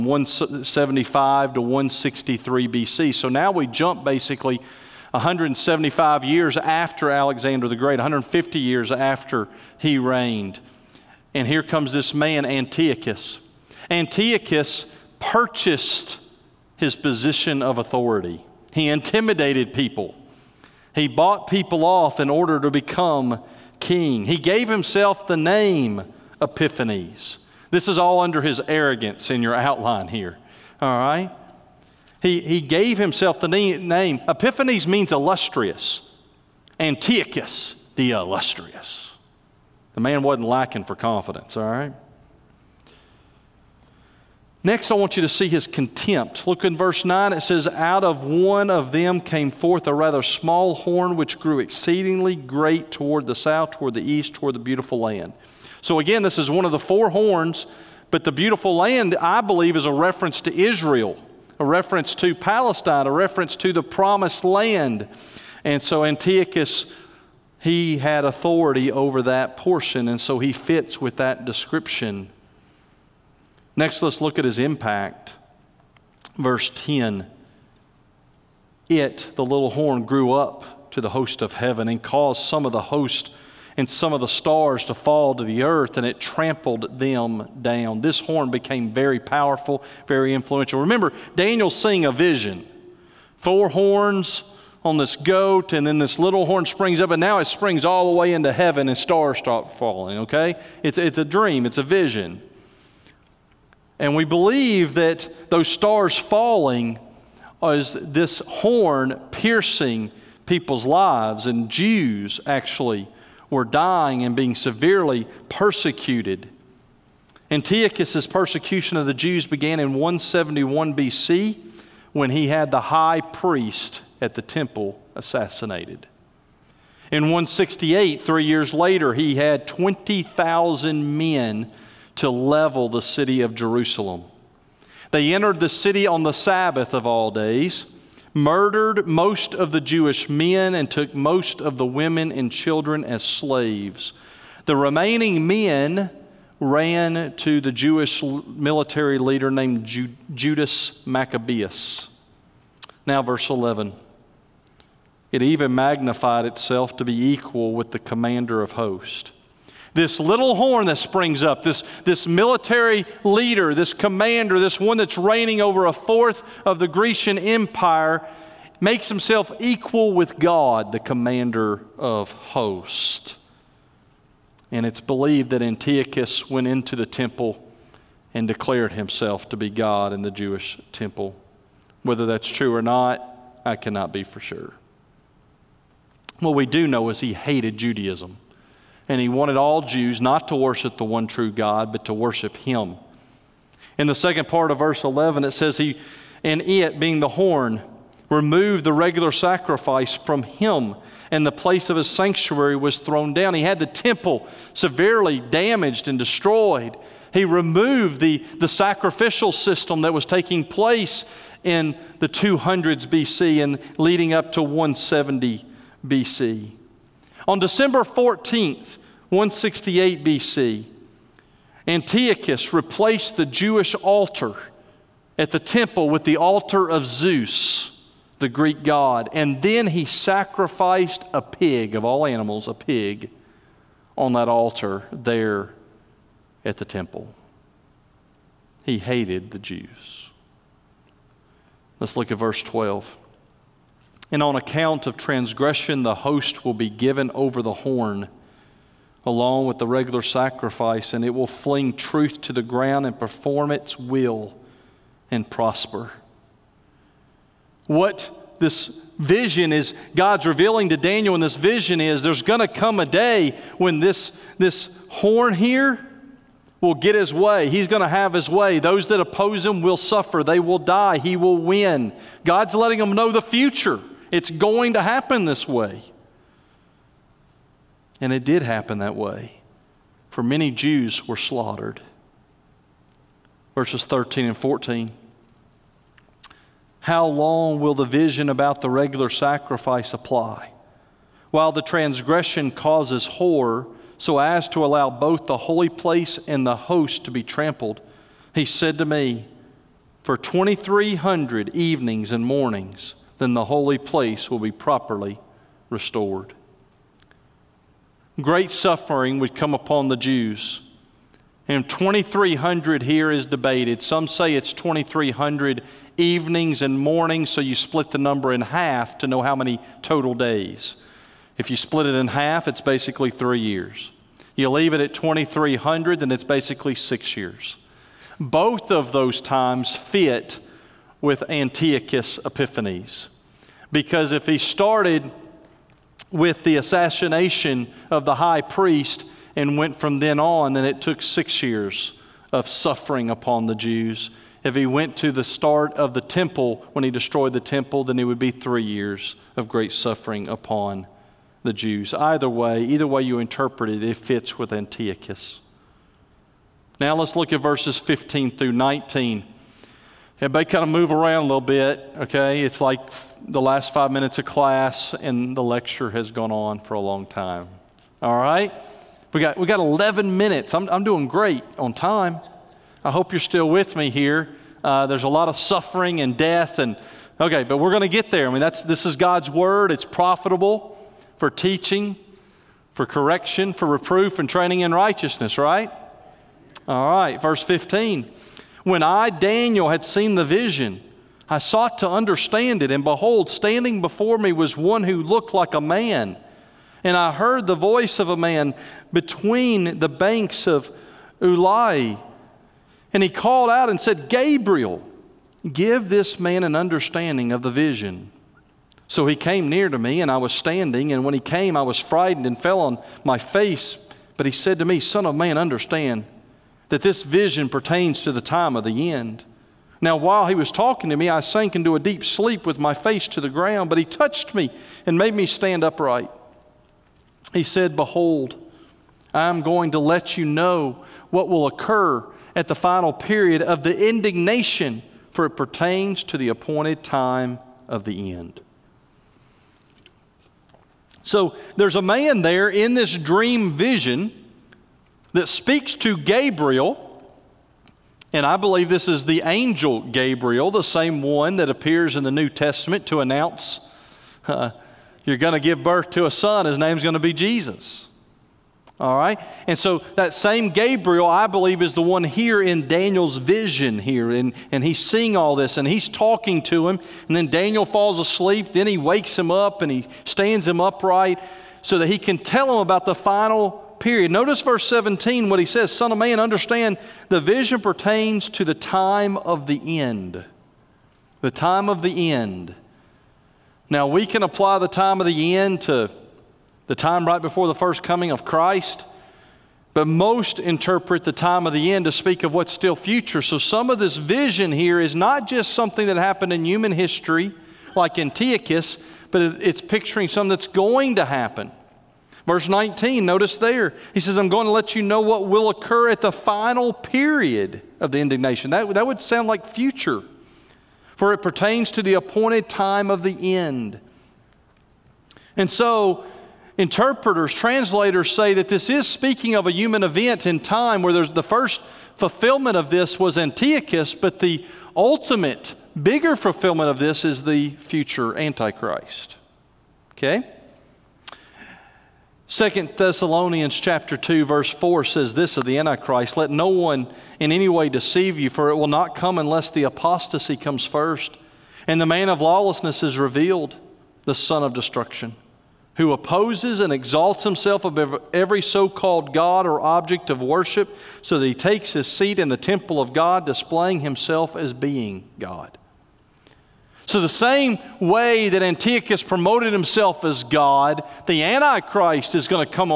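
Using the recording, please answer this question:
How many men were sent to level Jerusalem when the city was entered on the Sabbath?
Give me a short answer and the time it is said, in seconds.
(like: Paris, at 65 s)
20,000, at 129 s.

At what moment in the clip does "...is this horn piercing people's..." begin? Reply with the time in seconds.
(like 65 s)
107 s.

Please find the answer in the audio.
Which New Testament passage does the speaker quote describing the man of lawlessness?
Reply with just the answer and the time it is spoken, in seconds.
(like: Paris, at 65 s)
2 Thessalonians 2:4, at 532 s.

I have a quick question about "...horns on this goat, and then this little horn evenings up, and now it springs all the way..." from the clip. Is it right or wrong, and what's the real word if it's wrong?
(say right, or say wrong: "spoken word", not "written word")
wrong: "springs", not "evenings".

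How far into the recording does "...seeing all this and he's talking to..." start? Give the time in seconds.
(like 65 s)
464 s.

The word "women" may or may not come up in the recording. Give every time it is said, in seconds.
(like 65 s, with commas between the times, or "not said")
141 s.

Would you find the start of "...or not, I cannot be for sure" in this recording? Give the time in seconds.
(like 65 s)
182 s.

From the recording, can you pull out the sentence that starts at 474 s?
Notice verse 17 what he says Son of man, understand the vision pertains to the time of the end.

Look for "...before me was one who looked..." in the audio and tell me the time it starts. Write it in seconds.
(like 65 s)
394 s.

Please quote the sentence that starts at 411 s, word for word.
And when he came, I was frightened and fell on my face.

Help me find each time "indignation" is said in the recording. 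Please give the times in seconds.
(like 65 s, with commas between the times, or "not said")
434 s, 508 s.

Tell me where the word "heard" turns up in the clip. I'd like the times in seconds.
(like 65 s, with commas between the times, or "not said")
397 s.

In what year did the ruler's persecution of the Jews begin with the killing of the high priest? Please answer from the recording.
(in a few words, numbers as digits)
171 BC.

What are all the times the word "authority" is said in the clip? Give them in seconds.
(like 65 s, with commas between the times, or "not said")
17 s, 68 s.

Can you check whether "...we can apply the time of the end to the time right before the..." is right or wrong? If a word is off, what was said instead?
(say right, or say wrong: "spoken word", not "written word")
right.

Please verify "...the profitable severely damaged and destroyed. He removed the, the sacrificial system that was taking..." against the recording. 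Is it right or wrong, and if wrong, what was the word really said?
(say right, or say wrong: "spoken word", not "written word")
wrong: "temple", not "profitable".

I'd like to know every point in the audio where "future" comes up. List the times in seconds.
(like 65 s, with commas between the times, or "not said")
273 s, 492 s, 509 s, 527 s.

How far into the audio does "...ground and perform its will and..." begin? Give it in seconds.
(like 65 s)
252 s.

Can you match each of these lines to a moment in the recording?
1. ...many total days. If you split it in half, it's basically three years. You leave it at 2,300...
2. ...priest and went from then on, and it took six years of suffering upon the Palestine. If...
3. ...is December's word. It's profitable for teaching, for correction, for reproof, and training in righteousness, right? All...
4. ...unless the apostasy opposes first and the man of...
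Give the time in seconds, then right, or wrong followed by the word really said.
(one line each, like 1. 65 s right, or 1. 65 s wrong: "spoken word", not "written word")
1. 319 s right
2. 338 s wrong: "Jews", not "Palestine"
3. 379 s wrong: "God", not "December"
4. 539 s wrong: "comes", not "opposes".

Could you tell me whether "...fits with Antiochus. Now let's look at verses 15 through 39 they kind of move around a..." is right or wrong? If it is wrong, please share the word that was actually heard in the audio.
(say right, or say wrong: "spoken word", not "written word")
wrong: "19", not "39".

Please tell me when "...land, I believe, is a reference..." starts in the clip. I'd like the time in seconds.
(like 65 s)
58 s.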